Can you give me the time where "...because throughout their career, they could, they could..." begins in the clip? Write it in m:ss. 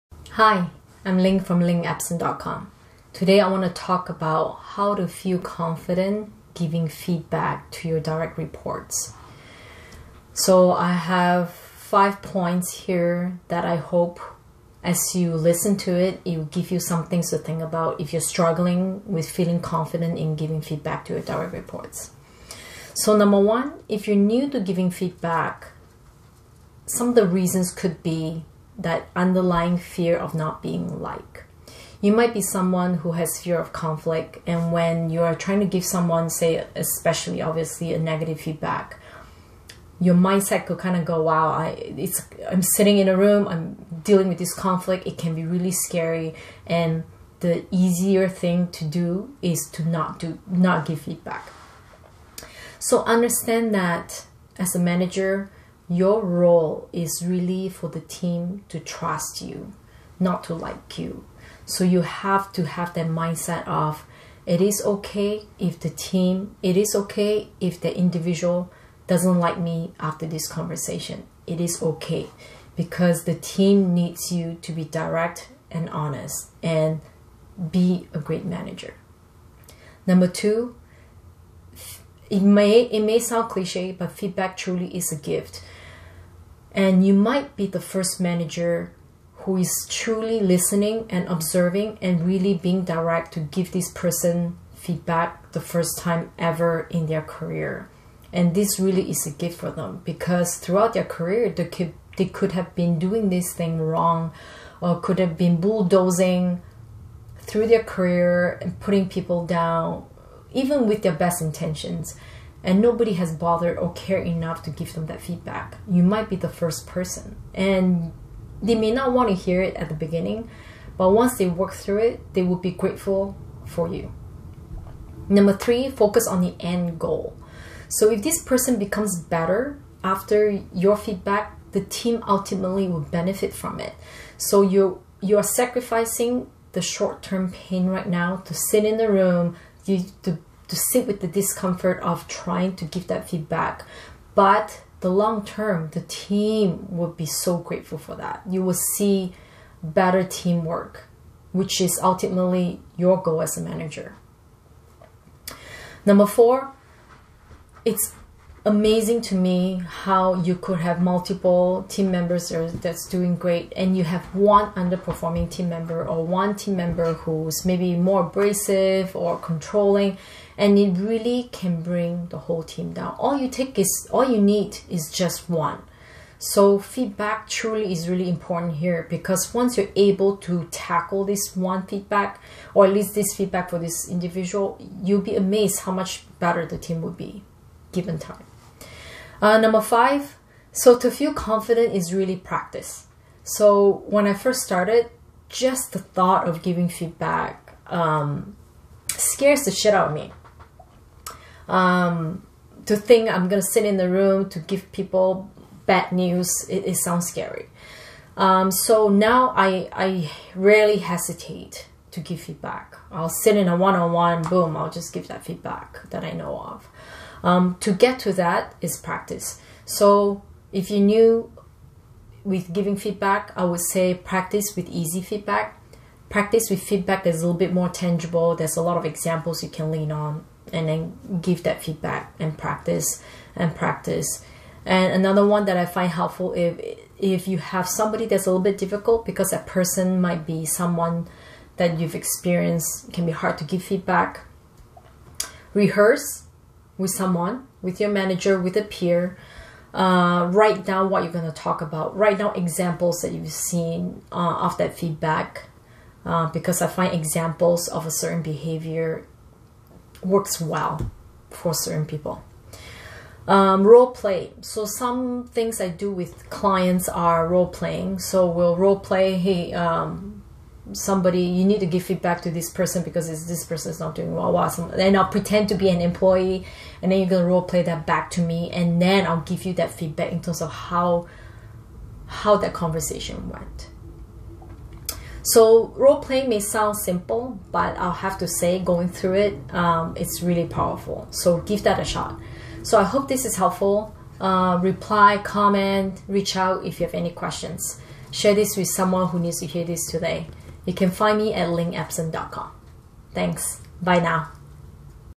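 1:40.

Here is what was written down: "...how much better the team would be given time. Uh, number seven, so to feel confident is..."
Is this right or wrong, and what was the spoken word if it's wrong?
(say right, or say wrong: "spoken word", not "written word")
wrong: "five", not "seven".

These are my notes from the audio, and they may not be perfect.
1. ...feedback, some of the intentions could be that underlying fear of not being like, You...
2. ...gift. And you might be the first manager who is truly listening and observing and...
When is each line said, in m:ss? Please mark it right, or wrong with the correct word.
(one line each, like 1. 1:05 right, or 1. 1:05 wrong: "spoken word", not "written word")
1. 0:24 wrong: "reasons", not "intentions"
2. 1:25 right.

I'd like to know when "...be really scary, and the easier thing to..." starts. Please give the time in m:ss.
0:45.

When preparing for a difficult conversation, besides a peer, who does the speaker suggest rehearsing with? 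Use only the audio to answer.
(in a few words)
Your manager.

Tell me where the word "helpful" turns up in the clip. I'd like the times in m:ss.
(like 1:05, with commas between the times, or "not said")
3:56, 4:53.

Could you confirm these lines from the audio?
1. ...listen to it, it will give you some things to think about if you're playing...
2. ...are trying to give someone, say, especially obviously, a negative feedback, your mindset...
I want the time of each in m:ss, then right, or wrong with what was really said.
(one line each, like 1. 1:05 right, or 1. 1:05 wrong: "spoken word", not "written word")
1. 0:15 wrong: "struggling", not "playing"
2. 0:35 right.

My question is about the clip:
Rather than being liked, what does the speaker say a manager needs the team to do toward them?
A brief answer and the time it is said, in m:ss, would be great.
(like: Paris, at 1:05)
Trust, at 0:58.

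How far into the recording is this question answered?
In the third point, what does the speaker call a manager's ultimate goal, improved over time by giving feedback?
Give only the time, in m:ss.
2:30.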